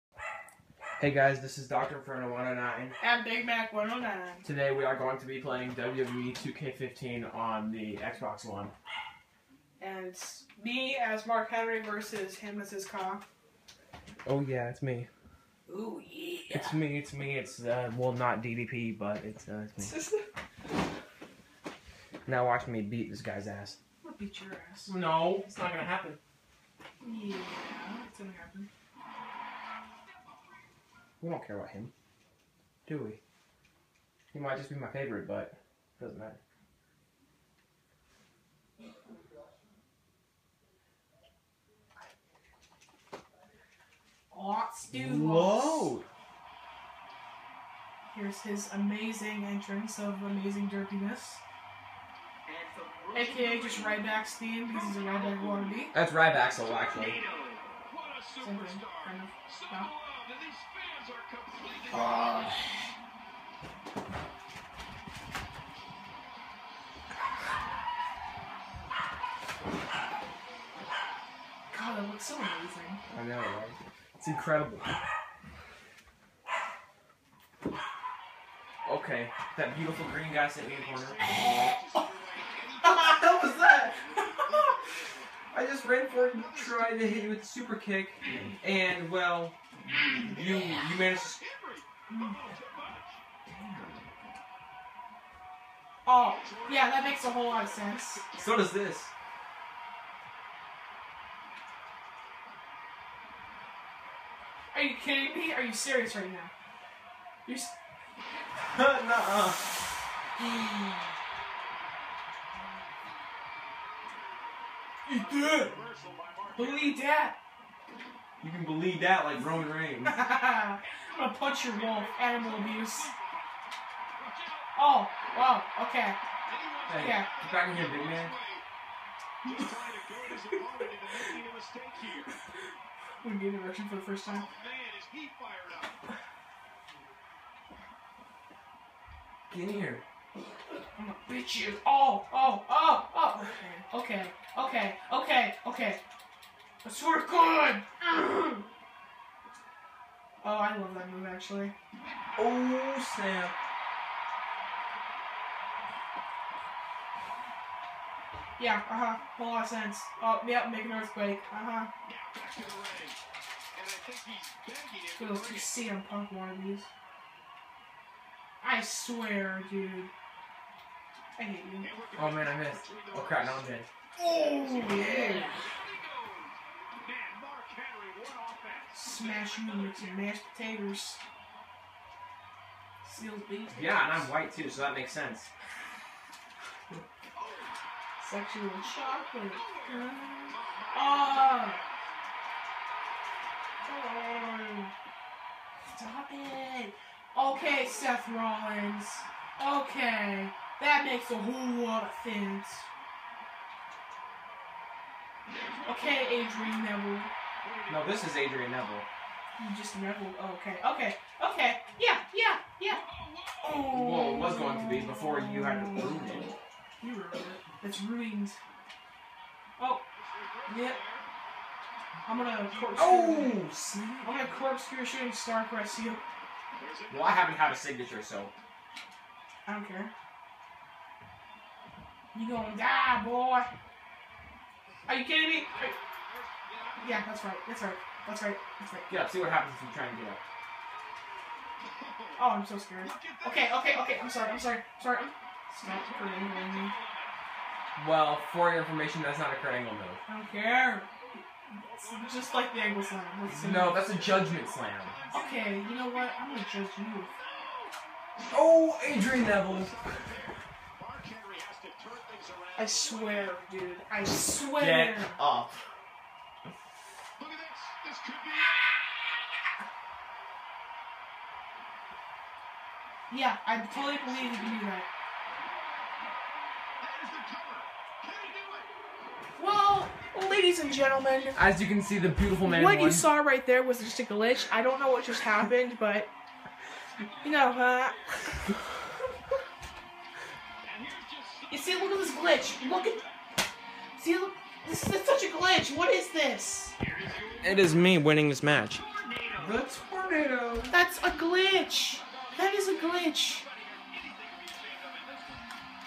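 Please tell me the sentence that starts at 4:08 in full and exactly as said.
Well, for your information, that's not a Kurt Angle move.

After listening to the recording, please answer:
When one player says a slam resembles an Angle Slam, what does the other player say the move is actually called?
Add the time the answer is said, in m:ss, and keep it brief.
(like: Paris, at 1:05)
Judgment slam, at 4:14.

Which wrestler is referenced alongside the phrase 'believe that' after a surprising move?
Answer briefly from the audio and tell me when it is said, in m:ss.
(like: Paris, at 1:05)
Roman Reigns, at 1:59.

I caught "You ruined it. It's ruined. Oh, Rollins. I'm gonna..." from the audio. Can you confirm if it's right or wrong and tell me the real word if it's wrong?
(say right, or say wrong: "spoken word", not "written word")
wrong: "Yep", not "Rollins".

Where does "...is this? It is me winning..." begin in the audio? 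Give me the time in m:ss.
4:56.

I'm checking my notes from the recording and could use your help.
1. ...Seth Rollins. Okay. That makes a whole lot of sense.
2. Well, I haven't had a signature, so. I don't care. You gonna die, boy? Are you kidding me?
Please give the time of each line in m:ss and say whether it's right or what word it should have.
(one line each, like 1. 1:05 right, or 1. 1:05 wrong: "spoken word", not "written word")
1. 3:17 right
2. 3:47 right.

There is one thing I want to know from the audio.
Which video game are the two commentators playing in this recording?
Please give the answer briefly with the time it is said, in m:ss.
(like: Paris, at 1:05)
WWE 2K15, at 0:05.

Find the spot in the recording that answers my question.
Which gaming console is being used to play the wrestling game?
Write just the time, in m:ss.
0:07.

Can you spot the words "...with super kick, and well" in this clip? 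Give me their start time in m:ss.
1:27.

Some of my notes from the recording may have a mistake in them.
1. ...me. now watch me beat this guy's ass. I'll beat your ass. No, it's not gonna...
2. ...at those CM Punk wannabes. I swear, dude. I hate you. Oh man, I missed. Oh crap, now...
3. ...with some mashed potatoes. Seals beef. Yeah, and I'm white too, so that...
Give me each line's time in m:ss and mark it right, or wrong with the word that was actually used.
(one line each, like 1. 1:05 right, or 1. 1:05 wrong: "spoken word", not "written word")
1. 0:20 right
2. 2:45 right
3. 2:59 right.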